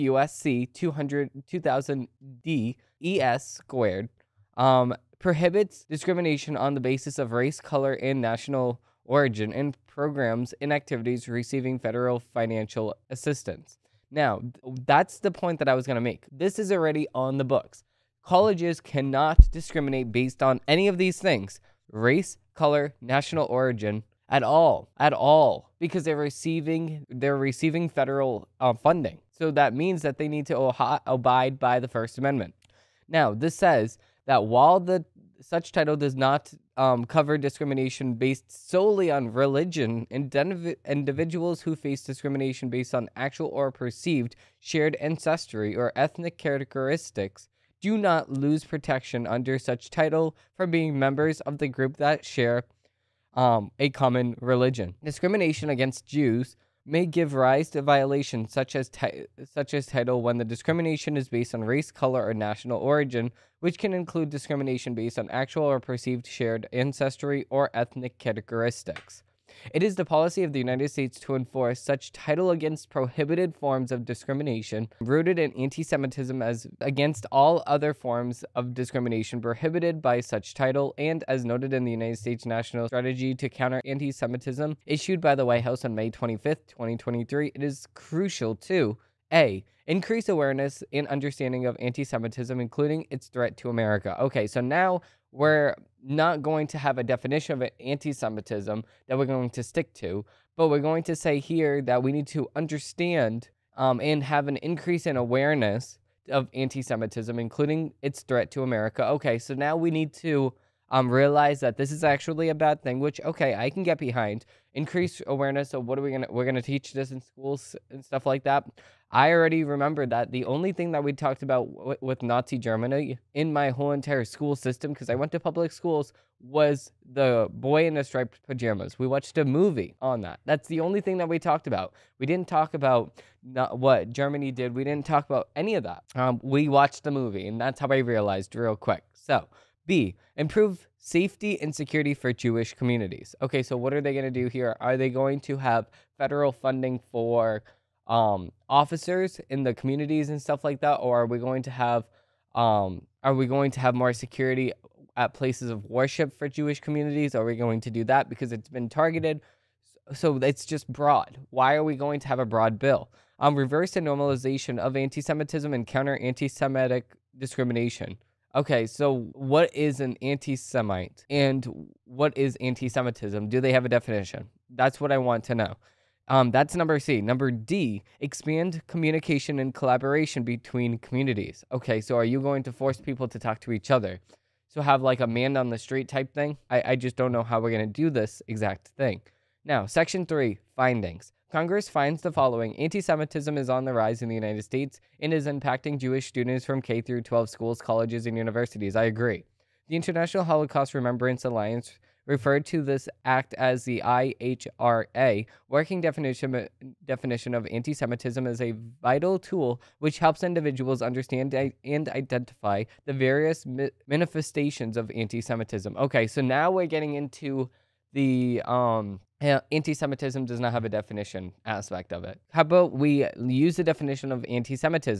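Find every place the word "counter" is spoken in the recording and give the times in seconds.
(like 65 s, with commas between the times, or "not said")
83 s, 165 s.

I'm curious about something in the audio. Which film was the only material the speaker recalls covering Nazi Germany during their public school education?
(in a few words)
The Boy in the Striped Pajamas.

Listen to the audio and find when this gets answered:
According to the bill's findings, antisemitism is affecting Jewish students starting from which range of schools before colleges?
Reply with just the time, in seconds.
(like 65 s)
196 s.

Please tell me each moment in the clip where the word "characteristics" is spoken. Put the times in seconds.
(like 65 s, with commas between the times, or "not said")
46 s, 68 s.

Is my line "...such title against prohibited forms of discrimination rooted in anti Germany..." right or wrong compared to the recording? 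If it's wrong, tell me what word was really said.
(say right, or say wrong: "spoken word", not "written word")
wrong: "Semitism", not "Germany".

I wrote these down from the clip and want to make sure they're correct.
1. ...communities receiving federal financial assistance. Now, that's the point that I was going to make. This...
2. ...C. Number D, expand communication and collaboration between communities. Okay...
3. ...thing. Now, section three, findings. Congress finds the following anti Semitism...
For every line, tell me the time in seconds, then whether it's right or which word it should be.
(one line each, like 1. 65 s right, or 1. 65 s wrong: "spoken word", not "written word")
1. 10 s wrong: "activities", not "communities"
2. 176 s right
3. 188 s right.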